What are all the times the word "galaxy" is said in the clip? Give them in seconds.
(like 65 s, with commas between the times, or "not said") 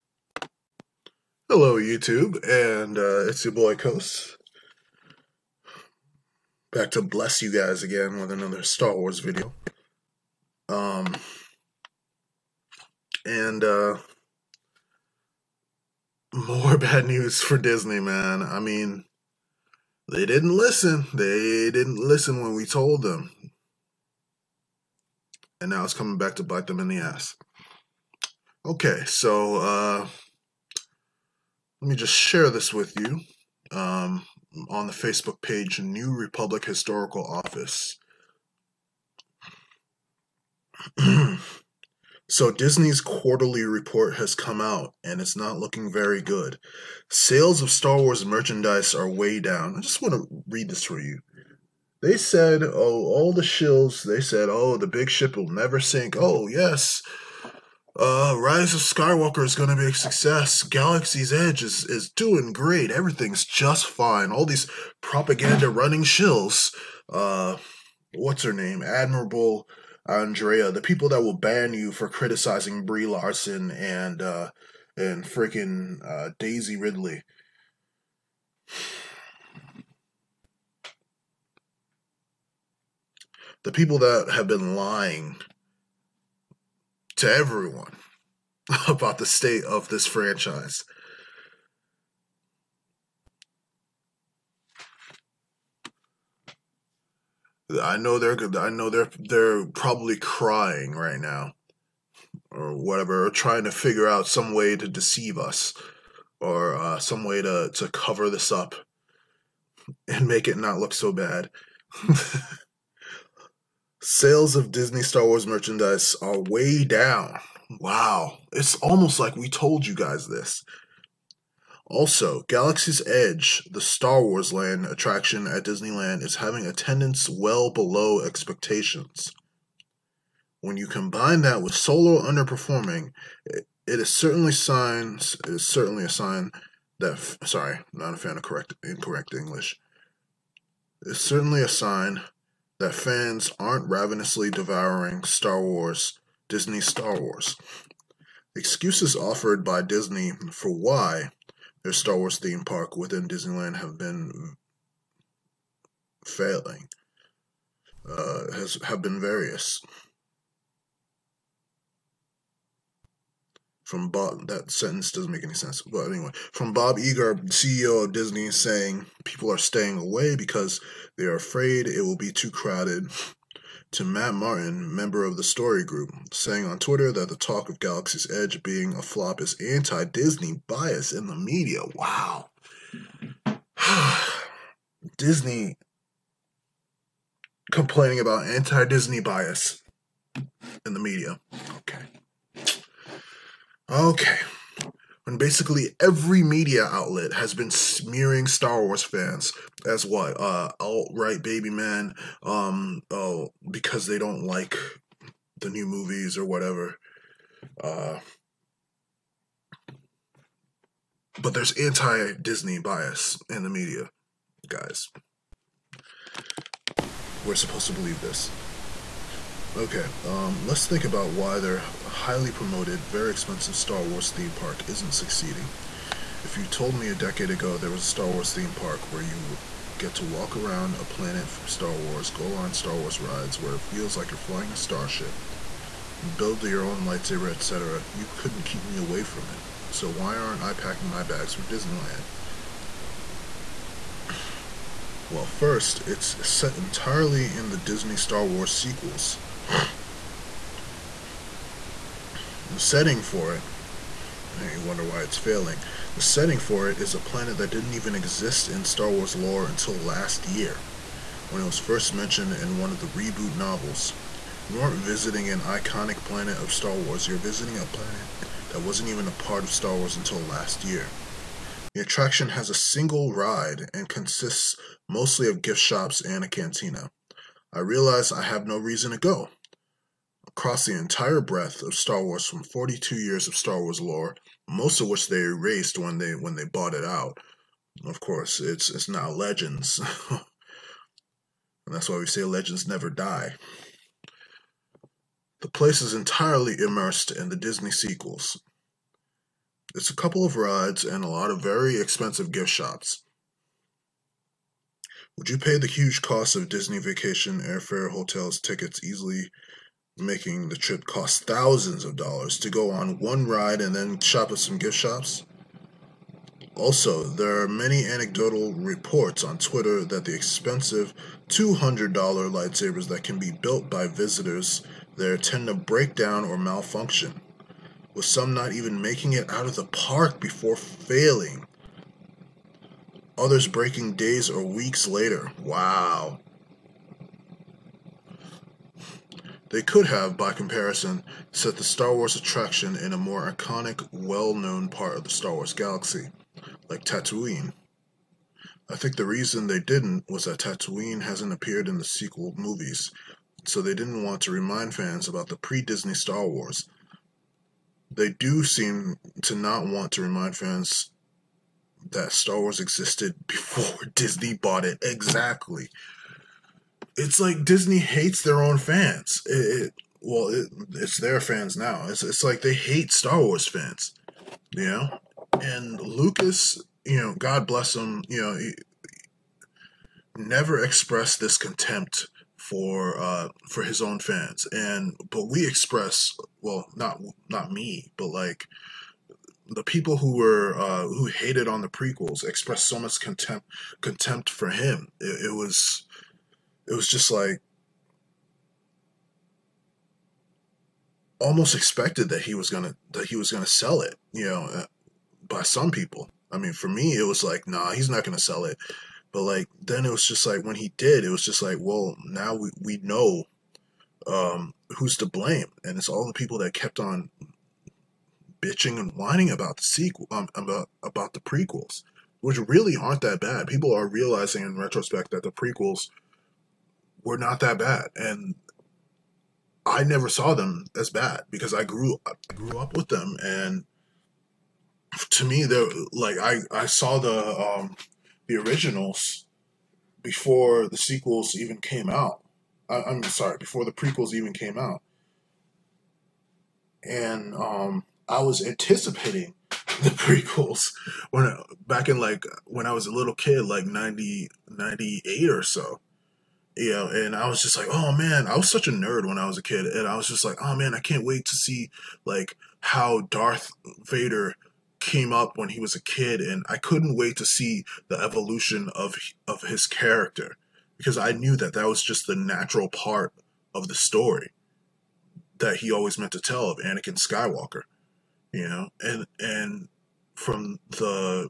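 60 s, 122 s, 177 s, 345 s.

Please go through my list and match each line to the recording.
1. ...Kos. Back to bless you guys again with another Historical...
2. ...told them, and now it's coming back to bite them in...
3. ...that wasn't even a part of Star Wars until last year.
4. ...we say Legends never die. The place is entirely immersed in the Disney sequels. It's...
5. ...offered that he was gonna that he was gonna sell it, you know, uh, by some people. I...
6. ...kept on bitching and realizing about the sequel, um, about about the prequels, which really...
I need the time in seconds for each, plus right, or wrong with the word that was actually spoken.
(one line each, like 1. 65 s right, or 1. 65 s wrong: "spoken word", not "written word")
1. 3 s wrong: "Star", not "Historical"
2. 22 s right
3. 268 s right
4. 292 s right
5. 401 s wrong: "expected", not "offered"
6. 416 s wrong: "whining", not "realizing".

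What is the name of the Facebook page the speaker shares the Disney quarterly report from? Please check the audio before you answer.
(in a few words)
New Republic Historical Office.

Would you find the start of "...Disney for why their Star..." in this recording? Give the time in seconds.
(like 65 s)
149 s.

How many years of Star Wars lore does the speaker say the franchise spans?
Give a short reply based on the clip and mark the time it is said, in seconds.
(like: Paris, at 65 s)
42, at 282 s.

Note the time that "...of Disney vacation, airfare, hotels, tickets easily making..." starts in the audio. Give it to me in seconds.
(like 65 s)
306 s.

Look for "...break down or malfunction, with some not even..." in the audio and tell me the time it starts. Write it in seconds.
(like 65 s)
325 s.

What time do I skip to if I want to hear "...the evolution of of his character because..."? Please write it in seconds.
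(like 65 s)
468 s.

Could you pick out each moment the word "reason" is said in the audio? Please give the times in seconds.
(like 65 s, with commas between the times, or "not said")
278 s, 349 s.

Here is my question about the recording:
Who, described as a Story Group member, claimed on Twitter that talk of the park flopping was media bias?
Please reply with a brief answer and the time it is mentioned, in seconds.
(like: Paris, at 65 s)
Matt Martin, at 174 s.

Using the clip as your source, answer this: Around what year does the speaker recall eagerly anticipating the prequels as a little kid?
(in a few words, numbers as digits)
1998.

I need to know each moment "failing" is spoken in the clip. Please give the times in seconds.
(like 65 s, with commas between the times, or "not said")
156 s, 255 s, 330 s.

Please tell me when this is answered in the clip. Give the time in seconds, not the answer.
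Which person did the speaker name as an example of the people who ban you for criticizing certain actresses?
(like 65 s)
68 s.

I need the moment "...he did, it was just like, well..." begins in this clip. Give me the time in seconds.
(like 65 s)
410 s.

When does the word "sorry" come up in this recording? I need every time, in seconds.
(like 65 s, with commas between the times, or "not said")
137 s, 443 s.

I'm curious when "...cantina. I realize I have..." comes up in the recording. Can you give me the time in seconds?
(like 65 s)
276 s.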